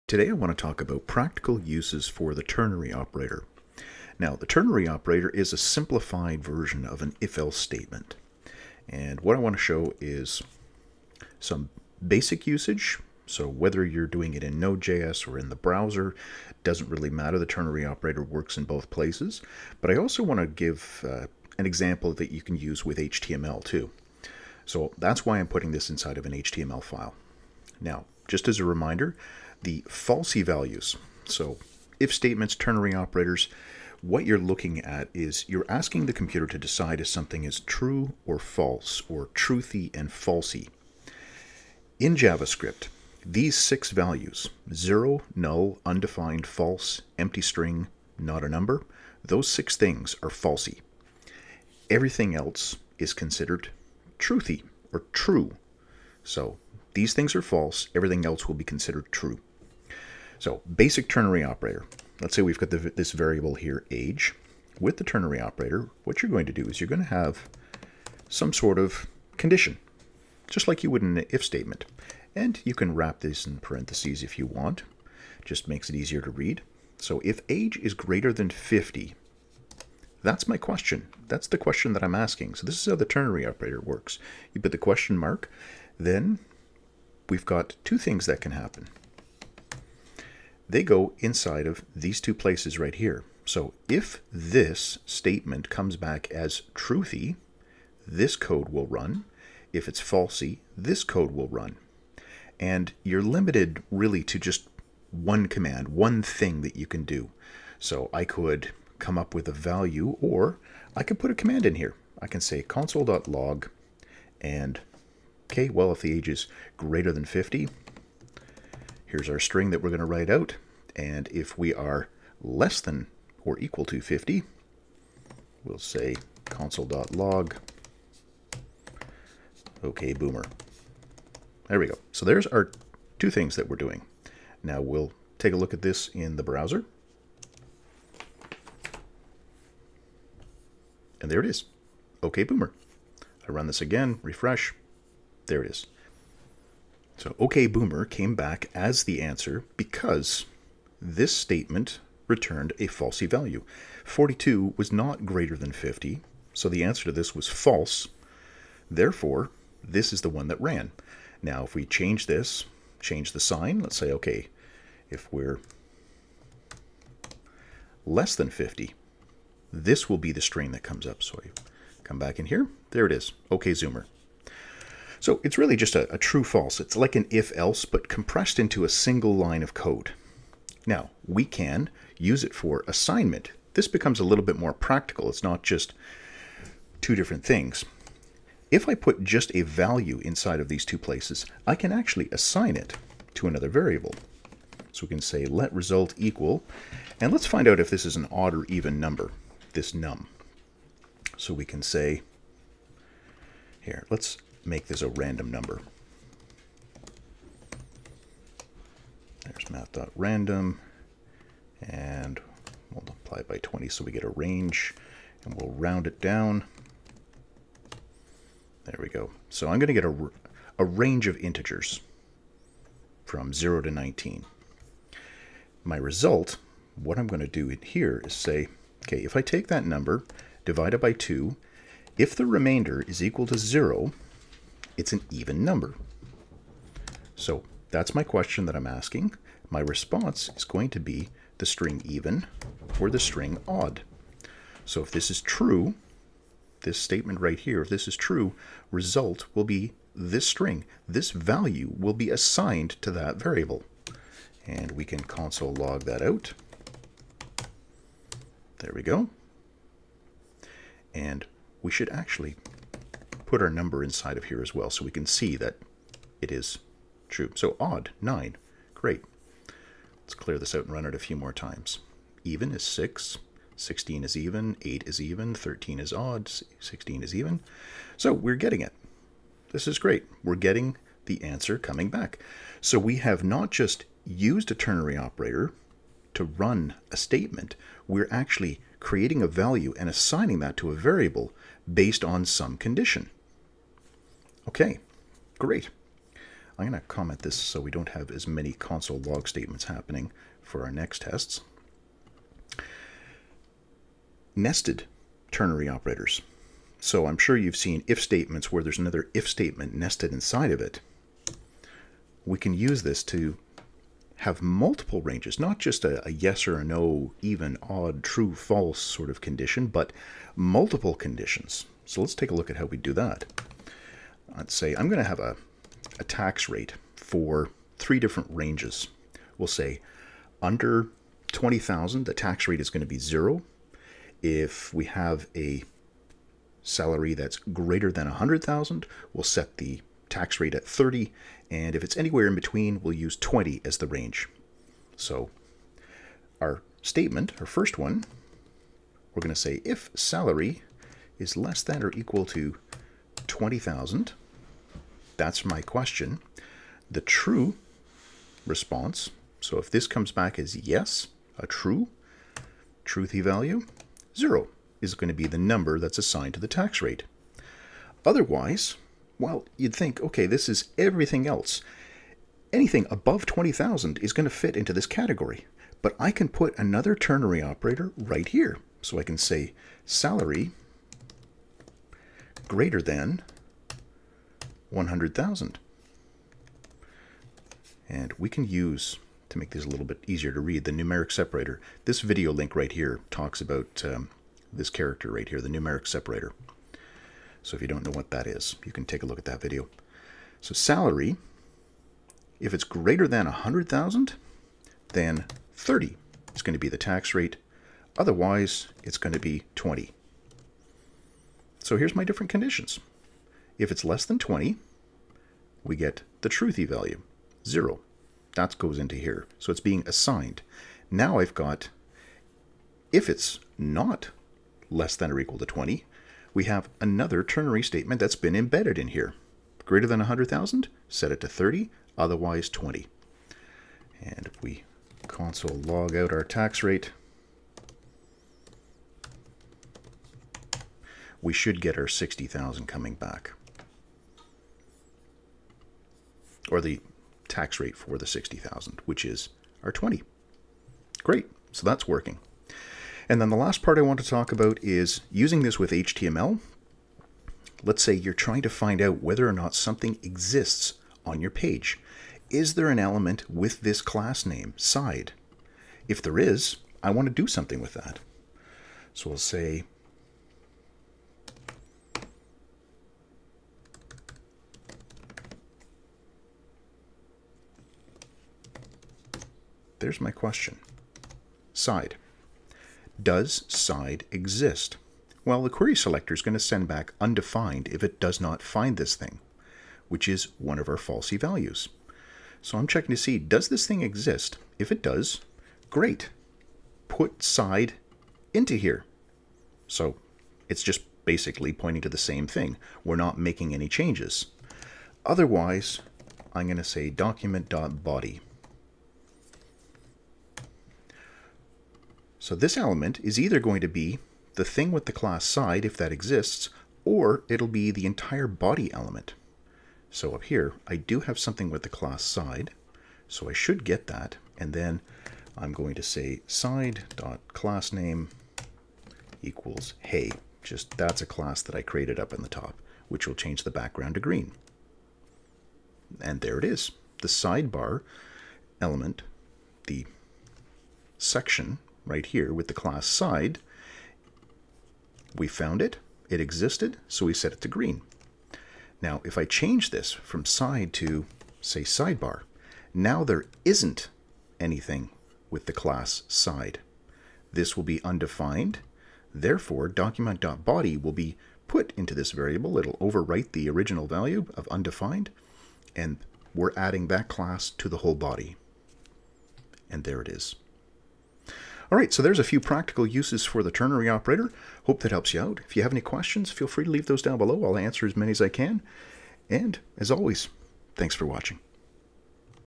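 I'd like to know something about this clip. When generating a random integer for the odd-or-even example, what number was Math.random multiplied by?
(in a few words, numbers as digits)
20.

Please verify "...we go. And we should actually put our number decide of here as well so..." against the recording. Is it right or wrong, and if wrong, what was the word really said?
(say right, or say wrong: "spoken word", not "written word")
wrong: "inside", not "decide".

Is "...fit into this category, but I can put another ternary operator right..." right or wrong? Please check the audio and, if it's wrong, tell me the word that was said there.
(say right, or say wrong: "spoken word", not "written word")
right.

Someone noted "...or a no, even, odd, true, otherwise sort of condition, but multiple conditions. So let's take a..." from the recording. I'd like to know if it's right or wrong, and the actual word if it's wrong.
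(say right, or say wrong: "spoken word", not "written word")
wrong: "false", not "otherwise".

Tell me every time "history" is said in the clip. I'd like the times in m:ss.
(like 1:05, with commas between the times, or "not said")
not said.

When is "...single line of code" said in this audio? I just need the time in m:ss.
2:58.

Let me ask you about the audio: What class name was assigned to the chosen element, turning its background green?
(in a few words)
hey.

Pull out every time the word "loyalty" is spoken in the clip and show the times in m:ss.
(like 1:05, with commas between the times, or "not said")
not said.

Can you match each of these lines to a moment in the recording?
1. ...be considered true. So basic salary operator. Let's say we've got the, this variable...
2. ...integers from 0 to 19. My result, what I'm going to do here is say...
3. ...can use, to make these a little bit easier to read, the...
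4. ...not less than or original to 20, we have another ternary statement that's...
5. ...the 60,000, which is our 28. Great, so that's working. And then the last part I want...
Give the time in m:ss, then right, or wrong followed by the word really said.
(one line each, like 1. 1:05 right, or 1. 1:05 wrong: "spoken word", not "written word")
1. 0:58 wrong: "ternary", not "salary"
2. 3:41 right
3. 6:28 right
4. 7:03 wrong: "equal", not "original"
5. 7:28 wrong: "20", not "28".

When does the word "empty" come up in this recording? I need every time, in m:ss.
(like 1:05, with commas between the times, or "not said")
0:47.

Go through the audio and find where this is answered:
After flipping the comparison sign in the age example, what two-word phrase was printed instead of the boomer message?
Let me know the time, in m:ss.
2:53.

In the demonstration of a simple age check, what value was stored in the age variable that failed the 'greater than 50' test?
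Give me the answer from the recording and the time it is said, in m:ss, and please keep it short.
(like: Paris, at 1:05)
42, at 2:34.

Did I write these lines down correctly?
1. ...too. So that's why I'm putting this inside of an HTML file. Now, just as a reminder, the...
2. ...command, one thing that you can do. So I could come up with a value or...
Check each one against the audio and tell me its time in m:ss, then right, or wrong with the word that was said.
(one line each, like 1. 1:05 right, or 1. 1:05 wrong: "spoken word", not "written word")
1. 0:23 right
2. 1:45 right.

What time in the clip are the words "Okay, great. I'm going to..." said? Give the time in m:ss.
4:54.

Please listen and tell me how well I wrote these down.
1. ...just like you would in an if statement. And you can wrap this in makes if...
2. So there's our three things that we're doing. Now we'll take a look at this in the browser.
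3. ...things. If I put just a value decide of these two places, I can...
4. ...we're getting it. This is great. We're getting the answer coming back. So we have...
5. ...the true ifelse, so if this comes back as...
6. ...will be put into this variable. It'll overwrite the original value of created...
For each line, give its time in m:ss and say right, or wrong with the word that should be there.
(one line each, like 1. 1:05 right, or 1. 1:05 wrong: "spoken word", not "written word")
1. 1:10 wrong: "parentheses", not "makes"
2. 2:12 wrong: "two", not "three"
3. 3:07 wrong: "inside", not "decide"
4. 4:38 right
5. 5:57 wrong: "response", not "ifelse"
6. 9:20 wrong: "undefined", not "created".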